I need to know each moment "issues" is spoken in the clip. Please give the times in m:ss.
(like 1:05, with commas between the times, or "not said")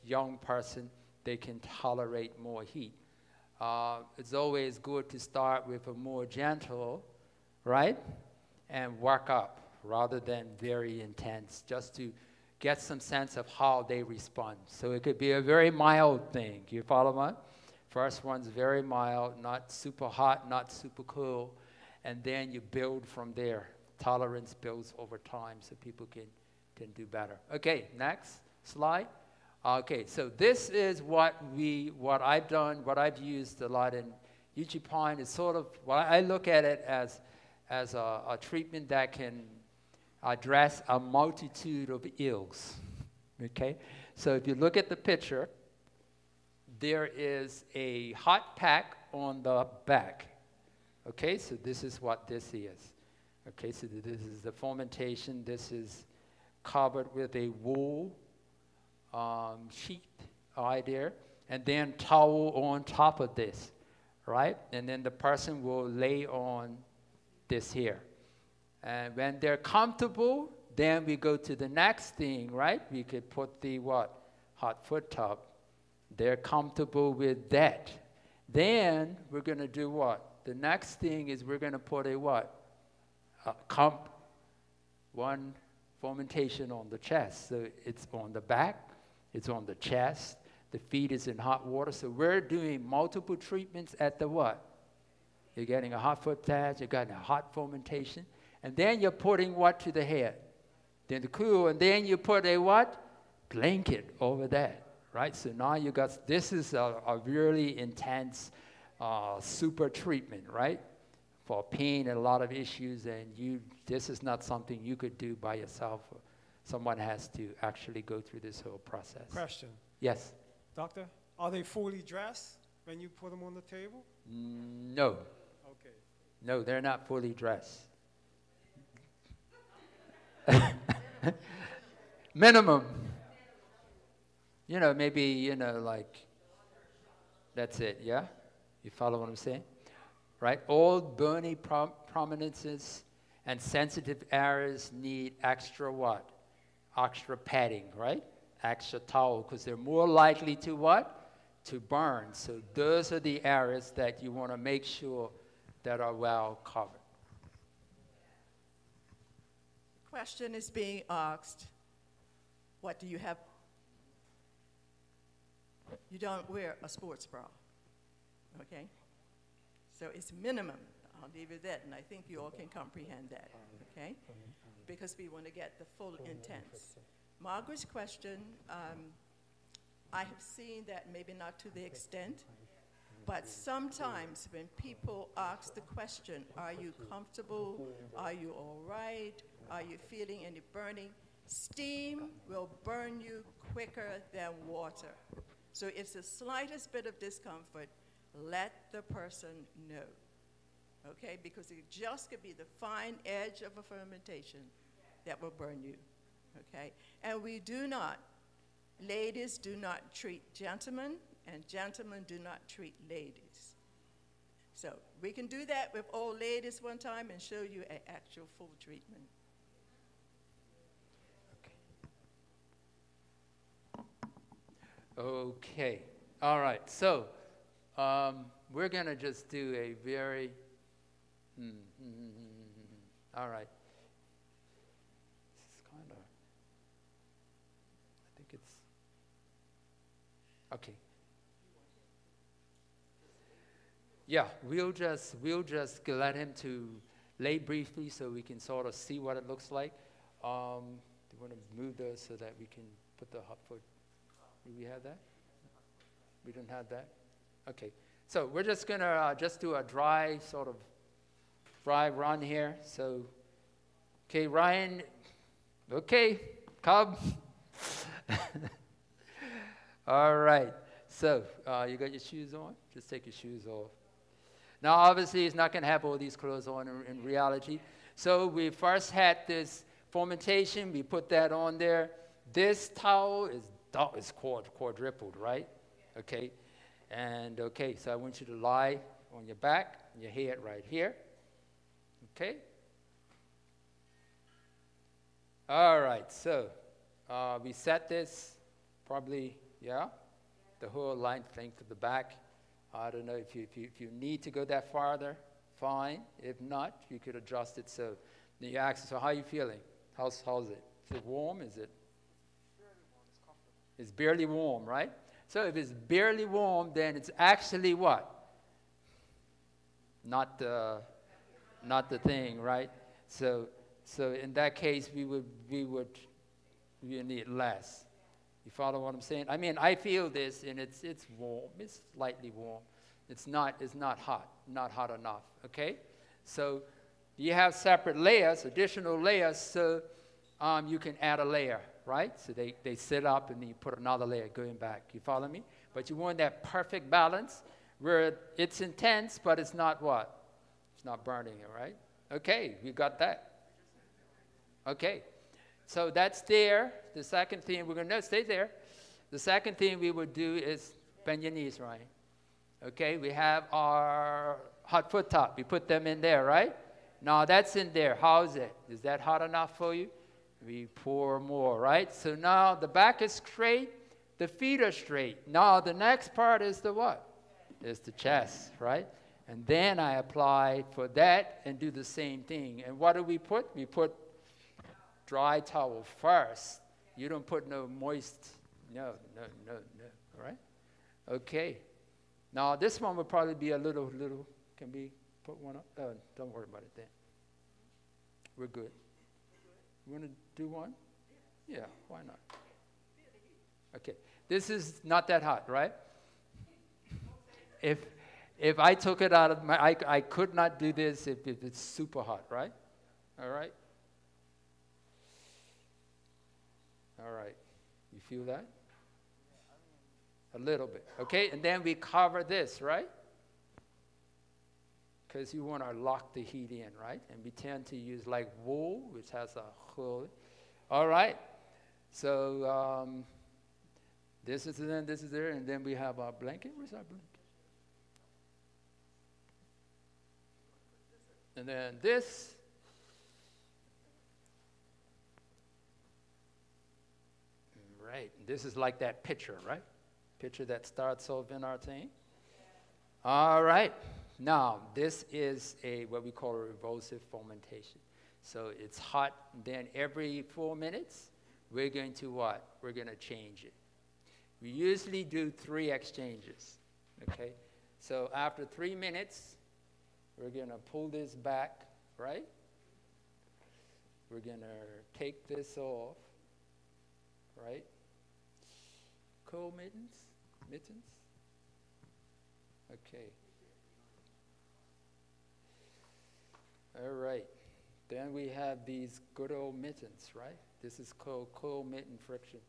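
1:52.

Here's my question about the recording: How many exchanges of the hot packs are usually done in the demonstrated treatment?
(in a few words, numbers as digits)
3.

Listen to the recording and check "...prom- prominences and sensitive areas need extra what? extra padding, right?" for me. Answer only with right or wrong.
right.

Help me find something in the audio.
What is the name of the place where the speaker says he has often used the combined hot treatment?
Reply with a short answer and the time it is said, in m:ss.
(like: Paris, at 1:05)
Uchee Pine, at 0:34.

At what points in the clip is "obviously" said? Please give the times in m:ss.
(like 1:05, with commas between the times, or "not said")
4:34.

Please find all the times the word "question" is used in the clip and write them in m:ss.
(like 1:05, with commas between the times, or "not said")
1:59, 2:40, 2:57, 3:05.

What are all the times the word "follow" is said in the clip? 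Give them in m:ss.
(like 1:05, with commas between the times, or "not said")
0:16, 2:18, 5:28, 5:45.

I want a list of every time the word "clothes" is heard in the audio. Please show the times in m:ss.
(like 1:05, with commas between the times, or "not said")
4:36.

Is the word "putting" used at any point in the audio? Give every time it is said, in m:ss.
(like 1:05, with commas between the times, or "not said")
1:39.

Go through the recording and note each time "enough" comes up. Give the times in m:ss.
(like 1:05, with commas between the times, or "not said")
5:35, 6:09.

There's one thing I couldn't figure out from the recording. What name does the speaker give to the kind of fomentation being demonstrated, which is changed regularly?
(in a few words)
revulsive fomentation.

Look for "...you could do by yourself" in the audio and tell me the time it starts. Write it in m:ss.
1:54.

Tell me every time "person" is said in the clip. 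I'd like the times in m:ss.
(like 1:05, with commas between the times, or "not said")
0:00, 1:05, 3:19.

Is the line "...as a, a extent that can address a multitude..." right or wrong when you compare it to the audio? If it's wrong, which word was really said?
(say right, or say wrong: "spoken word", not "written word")
wrong: "treatment", not "extent".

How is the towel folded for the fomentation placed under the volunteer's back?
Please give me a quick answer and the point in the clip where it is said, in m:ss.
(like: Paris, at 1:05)
quadrupled, at 4:44.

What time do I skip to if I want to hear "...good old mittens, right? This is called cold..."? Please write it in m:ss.
8:09.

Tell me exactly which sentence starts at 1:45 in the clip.
So now you got, this is a, a really intense uh, super treatment, right?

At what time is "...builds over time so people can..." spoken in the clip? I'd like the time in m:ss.
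0:24.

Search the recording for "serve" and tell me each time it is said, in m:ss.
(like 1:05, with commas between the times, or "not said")
not said.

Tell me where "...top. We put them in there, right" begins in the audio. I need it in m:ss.
6:05.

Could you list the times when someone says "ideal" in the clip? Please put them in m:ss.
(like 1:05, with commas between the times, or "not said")
not said.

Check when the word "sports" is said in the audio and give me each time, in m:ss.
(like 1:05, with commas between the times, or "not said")
2:46.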